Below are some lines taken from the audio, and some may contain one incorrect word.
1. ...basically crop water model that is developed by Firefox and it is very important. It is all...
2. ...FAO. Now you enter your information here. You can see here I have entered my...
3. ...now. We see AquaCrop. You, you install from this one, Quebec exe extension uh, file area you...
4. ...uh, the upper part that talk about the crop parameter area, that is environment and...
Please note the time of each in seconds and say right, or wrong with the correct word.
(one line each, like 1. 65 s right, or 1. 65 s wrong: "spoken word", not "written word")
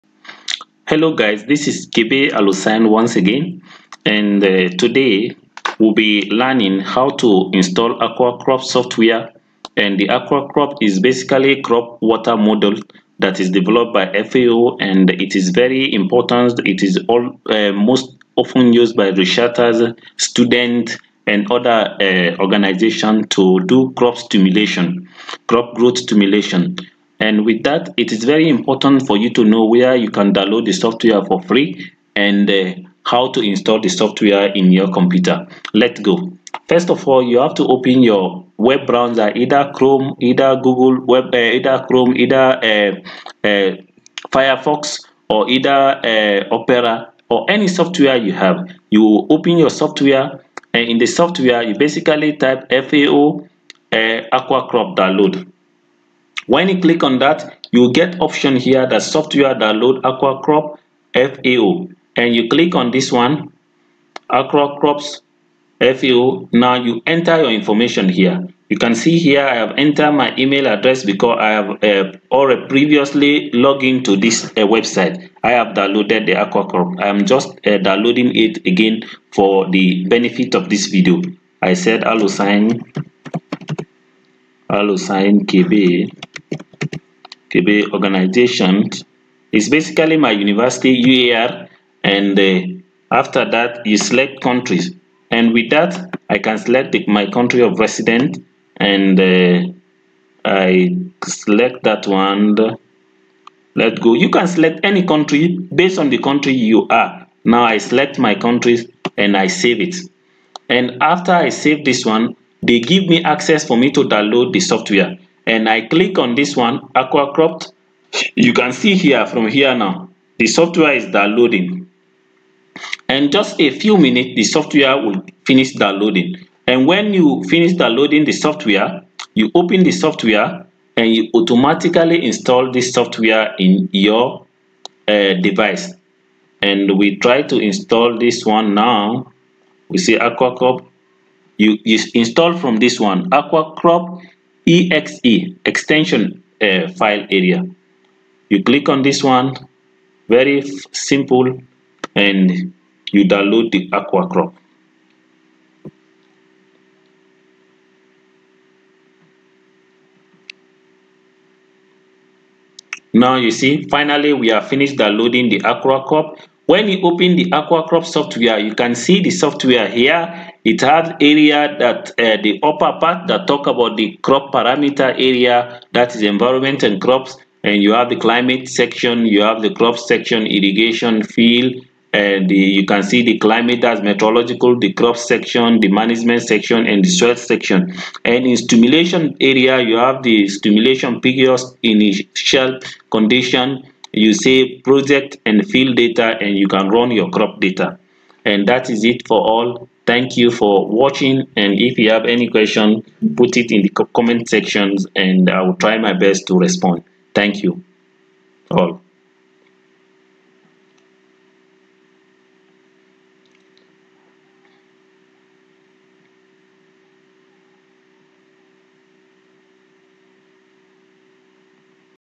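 1. 10 s wrong: "FAO", not "Firefox"
2. 65 s right
3. 138 s wrong: "AquaCrop", not "Quebec"
4. 172 s right.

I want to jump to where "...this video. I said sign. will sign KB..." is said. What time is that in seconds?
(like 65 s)
80 s.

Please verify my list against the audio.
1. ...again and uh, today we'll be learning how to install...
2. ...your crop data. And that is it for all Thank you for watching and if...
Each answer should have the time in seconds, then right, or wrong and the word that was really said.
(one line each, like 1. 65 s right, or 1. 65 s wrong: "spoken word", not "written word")
1. 3 s right
2. 197 s right.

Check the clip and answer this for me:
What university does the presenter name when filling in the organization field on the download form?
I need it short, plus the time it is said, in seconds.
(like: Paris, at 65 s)
UAR, at 91 s.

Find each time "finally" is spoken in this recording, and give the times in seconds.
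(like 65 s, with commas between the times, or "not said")
163 s.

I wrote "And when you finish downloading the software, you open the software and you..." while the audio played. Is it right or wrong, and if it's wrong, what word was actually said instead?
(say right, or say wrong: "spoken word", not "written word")
right.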